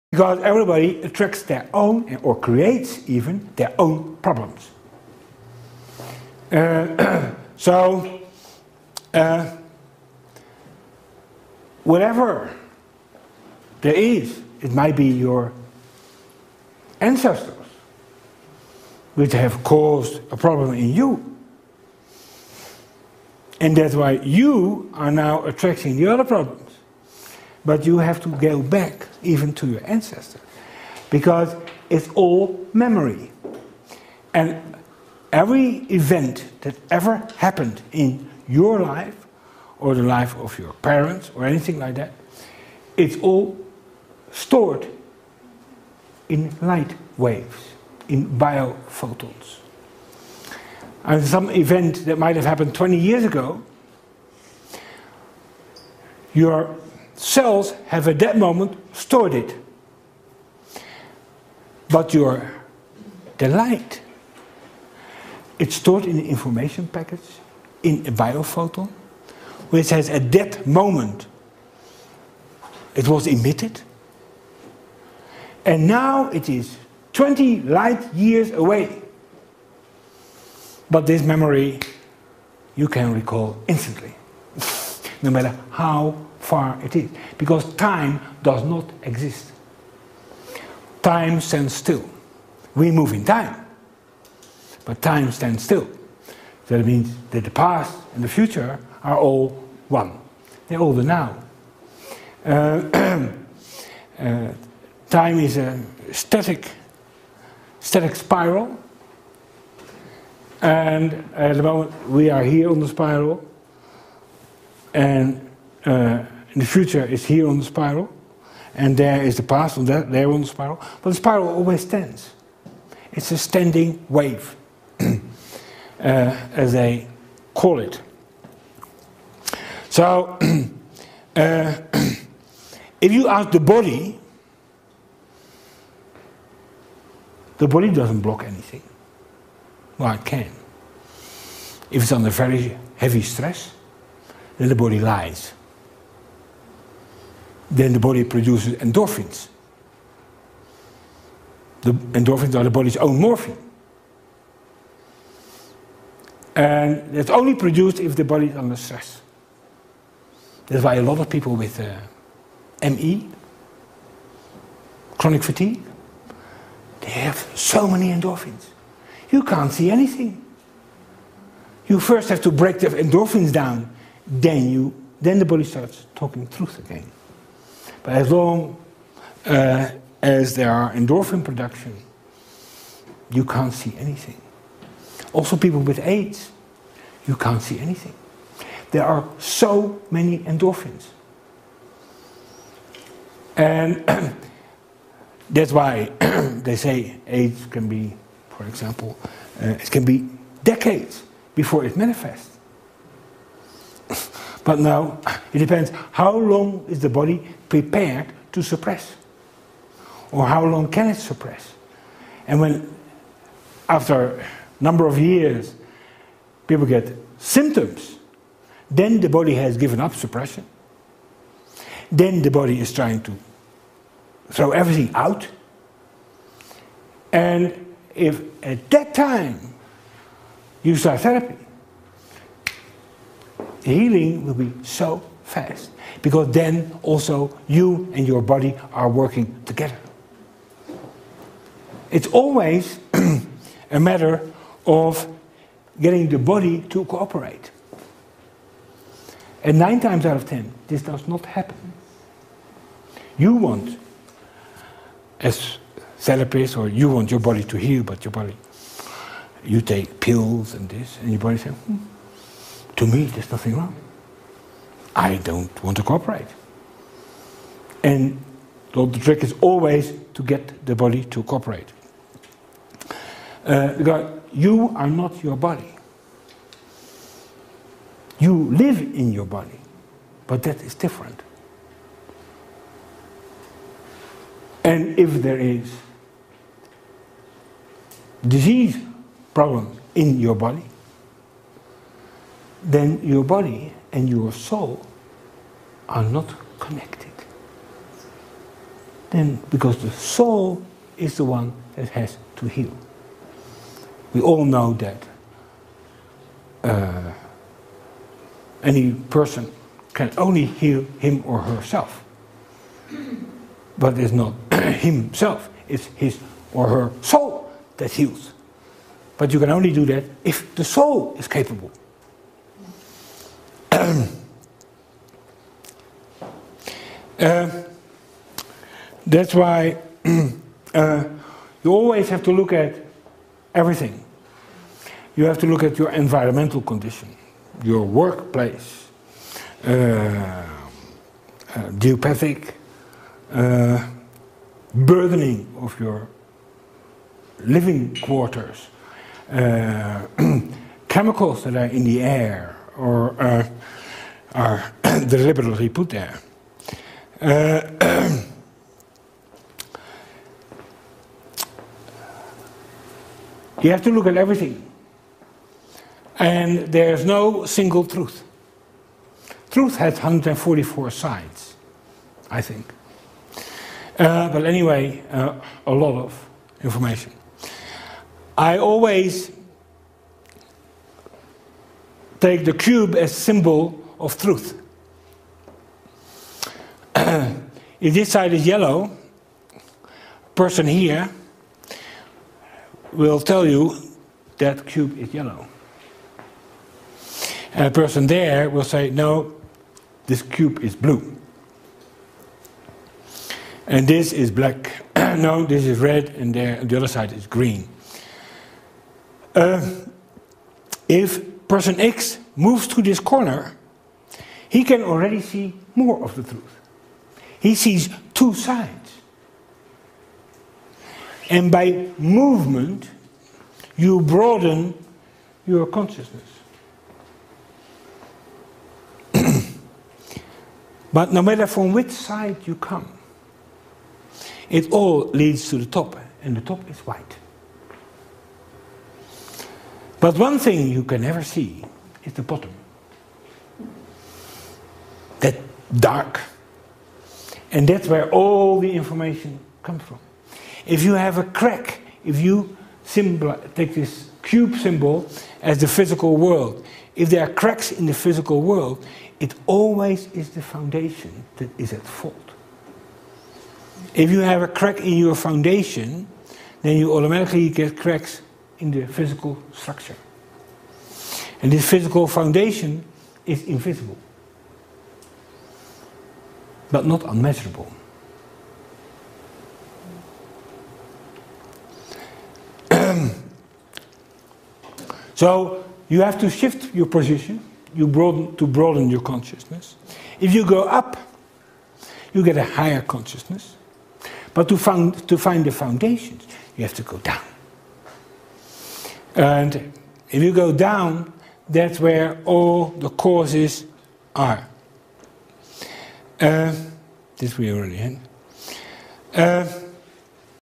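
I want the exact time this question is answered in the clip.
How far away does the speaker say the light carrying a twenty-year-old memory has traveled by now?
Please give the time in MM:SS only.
01:17.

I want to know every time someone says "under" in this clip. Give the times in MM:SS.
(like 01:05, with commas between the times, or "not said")
02:22, 02:38.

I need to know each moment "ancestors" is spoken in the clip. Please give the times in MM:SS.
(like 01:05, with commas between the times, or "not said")
00:16, 00:29.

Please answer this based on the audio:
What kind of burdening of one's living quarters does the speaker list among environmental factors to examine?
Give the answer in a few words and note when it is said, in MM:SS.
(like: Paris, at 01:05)
Geopathic, at 05:42.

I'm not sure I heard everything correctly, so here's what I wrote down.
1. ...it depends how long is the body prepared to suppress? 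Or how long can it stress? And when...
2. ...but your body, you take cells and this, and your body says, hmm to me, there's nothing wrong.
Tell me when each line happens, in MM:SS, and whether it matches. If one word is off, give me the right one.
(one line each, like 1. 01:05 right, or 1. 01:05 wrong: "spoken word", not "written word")
1. 03:25 wrong: "suppress", not "stress"
2. 04:18 wrong: "pills", not "cells".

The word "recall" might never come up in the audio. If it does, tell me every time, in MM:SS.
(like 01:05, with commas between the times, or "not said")
01:23.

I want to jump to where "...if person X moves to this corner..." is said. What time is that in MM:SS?
06:51.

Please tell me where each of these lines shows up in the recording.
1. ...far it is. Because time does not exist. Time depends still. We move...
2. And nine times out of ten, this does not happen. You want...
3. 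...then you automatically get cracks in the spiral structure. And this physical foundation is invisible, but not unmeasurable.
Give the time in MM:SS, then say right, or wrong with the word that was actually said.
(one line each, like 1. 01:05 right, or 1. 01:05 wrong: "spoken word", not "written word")
1. 01:26 wrong: "stands", not "depends"
2. 04:09 right
3. 07:46 wrong: "physical", not "spiral".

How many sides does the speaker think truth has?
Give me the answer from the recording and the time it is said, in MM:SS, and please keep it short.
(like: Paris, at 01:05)
144, at 06:10.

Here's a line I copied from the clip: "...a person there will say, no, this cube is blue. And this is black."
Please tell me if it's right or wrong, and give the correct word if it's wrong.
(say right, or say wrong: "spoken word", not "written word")
right.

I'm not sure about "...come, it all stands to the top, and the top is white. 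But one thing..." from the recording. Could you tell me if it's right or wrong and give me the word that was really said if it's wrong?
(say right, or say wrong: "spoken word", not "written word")
wrong: "leads", not "stands".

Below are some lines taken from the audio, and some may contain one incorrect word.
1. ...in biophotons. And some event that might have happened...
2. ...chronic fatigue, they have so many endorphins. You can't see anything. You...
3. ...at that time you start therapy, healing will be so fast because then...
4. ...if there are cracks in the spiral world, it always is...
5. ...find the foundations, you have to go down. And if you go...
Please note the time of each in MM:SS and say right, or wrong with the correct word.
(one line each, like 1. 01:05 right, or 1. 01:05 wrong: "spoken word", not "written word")
1. 00:48 right
2. 02:45 right
3. 03:48 right
4. 07:37 wrong: "physical", not "spiral"
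5. 08:15 right.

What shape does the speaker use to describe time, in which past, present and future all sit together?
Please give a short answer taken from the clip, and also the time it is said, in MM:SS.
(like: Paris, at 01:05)
Static spiral, at 01:47.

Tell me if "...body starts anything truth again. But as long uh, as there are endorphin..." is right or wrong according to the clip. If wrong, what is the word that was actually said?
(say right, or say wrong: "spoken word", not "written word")
wrong: "talking", not "anything".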